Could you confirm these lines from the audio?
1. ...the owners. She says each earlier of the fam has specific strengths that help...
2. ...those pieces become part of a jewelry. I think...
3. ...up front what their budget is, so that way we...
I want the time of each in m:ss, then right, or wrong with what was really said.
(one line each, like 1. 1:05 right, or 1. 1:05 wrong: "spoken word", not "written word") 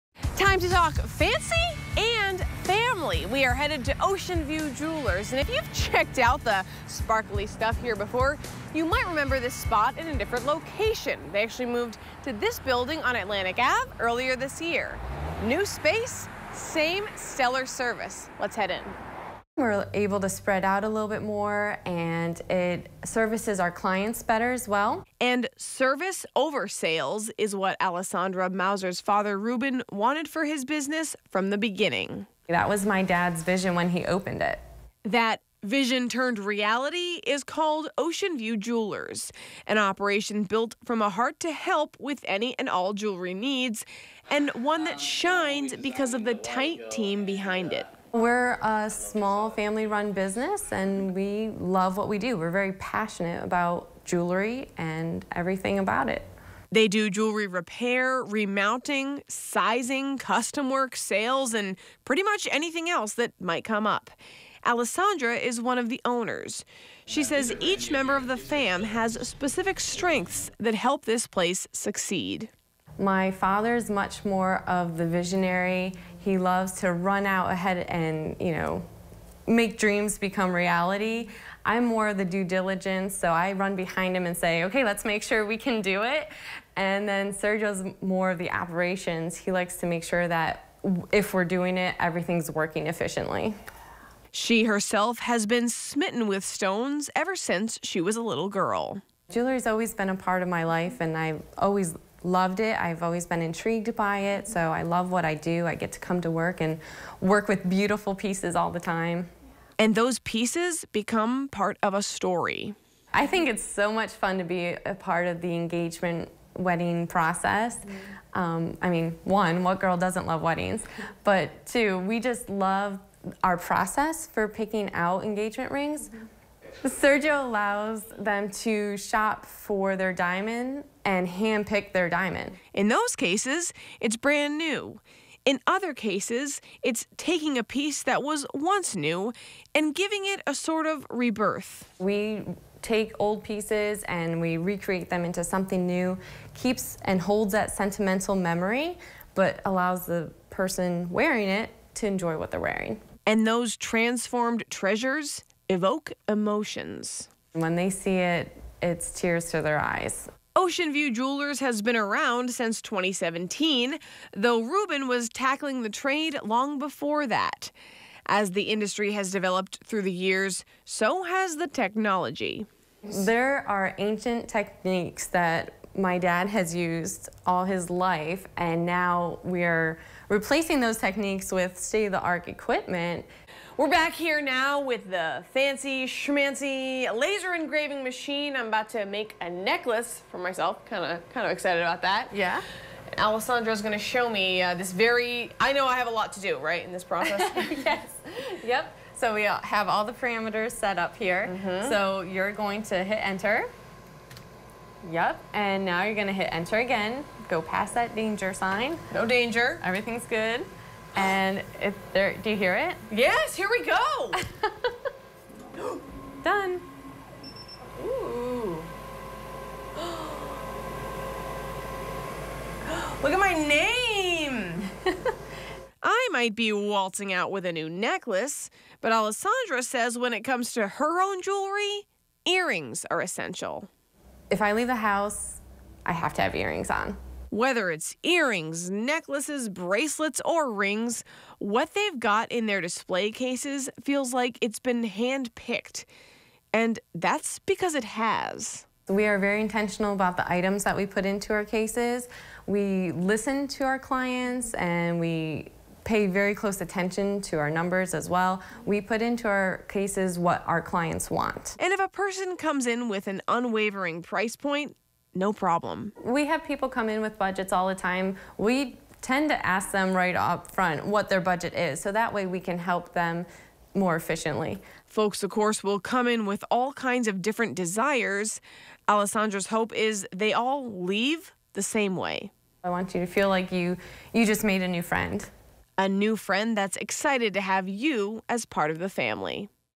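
1. 1:05 wrong: "member", not "earlier"
2. 1:49 wrong: "story", not "jewelry"
3. 4:30 right.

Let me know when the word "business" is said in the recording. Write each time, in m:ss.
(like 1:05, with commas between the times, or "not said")
0:30, 0:50.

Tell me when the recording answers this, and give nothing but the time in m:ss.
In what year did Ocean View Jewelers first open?
2:42.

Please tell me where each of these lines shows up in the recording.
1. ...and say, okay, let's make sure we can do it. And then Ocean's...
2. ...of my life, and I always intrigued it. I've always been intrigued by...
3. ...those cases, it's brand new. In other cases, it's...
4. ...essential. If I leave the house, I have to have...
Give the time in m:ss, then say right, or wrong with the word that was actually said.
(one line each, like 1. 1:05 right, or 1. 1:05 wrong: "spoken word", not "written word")
1. 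1:24 wrong: "Sergio", not "Ocean"
2. 1:40 wrong: "loved", not "intrigued"
3. 2:12 right
4. 3:53 right.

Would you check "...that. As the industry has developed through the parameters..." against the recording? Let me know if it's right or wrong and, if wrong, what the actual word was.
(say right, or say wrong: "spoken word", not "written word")
wrong: "years", not "parameters".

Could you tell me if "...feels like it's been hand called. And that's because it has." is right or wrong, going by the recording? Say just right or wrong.
wrong.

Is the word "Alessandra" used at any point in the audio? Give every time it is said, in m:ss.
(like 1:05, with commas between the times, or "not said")
0:27, 1:04, 3:13, 3:49, 4:39.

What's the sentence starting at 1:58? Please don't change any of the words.
Um, I mean, one, what girl doesn't love weddings?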